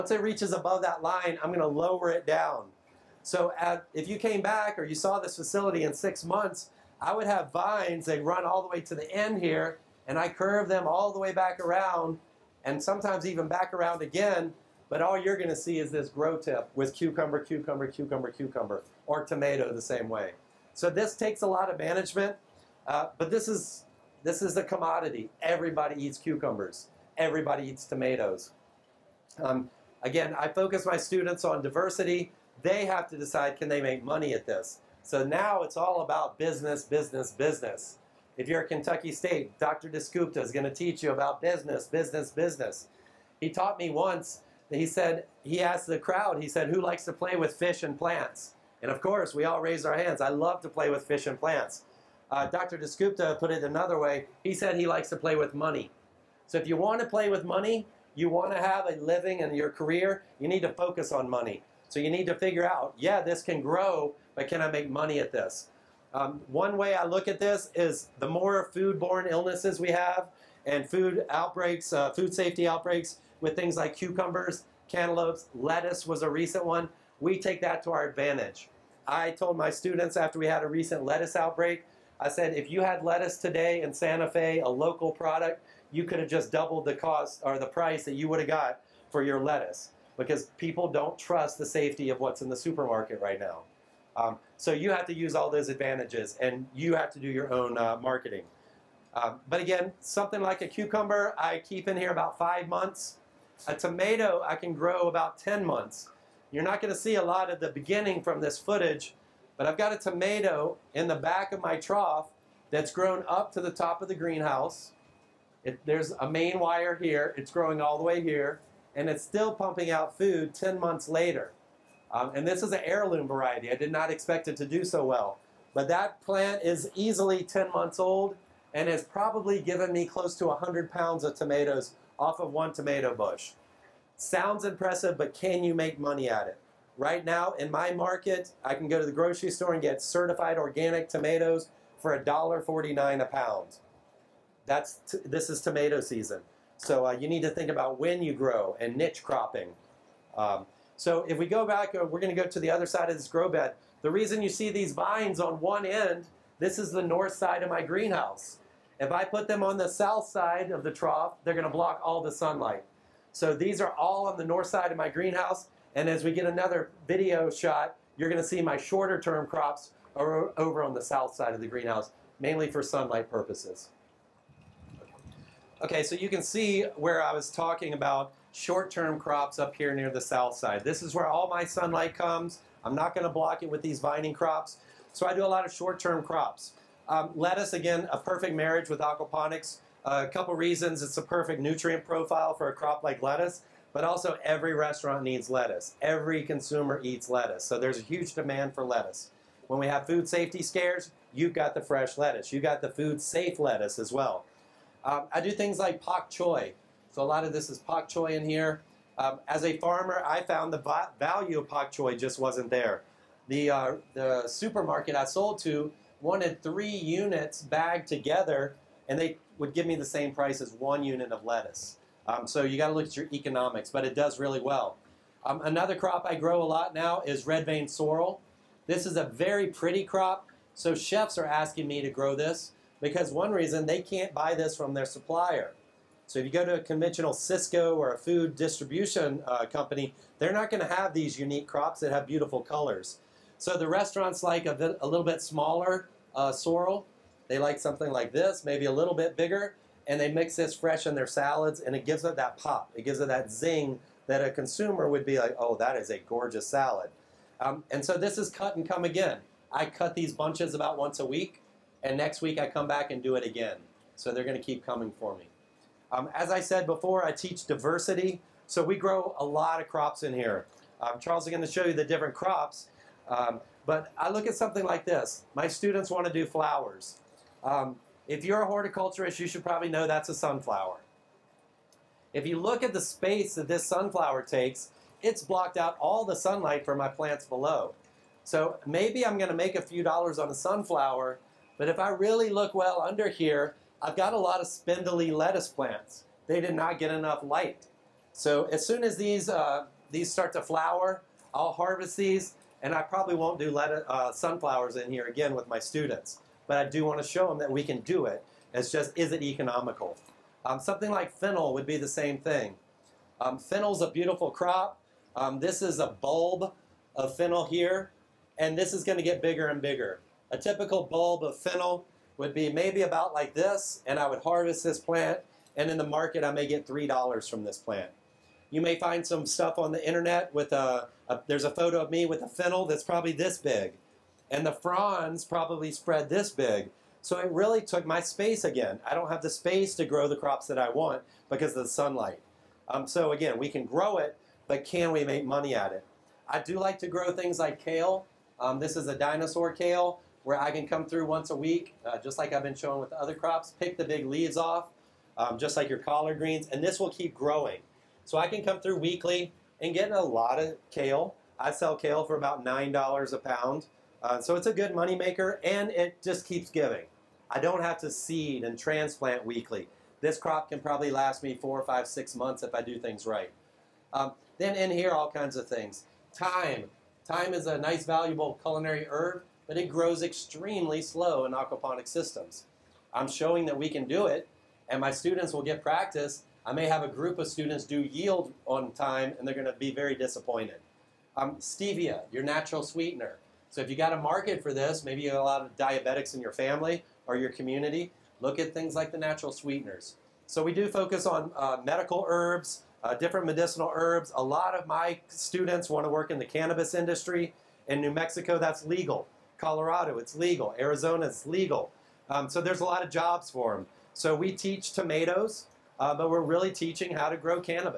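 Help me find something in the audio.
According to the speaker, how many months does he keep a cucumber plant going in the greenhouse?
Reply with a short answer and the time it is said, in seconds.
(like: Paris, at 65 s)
5 months, at 102 s.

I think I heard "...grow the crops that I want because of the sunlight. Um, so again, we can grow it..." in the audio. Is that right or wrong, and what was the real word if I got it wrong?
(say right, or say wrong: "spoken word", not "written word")
right.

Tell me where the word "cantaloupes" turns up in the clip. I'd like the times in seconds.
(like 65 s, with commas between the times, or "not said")
74 s.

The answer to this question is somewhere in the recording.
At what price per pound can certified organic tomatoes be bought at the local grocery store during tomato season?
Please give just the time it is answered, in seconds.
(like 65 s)
142 s.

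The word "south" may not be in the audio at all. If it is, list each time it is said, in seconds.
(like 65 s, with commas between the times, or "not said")
159 s, 171 s, 180 s.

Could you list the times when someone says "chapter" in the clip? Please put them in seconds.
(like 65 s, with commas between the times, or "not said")
not said.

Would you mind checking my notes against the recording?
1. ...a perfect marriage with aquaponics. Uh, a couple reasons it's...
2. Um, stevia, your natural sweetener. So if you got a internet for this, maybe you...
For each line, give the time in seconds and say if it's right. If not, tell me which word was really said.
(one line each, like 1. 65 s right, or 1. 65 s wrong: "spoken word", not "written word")
1. 188 s right
2. 391 s wrong: "market", not "internet".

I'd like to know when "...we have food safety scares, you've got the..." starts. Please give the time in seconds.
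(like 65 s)
199 s.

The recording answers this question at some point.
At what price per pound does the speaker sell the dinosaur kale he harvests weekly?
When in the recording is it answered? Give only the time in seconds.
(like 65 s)
362 s.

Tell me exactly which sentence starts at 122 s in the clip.
Um, and this is an heirloom variety.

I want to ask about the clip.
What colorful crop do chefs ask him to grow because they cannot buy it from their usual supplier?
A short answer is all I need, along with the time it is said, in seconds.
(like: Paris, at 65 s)
Red vein sorrel, at 227 s.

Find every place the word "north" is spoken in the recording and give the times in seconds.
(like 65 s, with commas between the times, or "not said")
157 s, 164 s.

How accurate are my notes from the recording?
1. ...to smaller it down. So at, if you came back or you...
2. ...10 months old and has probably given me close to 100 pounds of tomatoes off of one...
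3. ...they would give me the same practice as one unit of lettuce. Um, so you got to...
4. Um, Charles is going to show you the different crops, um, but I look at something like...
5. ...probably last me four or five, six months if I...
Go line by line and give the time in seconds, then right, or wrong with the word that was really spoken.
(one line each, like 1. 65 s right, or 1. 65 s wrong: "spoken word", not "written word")
1. 1 s wrong: "lower", not "smaller"
2. 127 s right
3. 219 s wrong: "price", not "practice"
4. 271 s right
5. 370 s right.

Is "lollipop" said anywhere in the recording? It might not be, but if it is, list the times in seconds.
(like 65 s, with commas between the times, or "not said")
not said.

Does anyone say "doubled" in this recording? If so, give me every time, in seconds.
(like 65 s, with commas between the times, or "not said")
86 s.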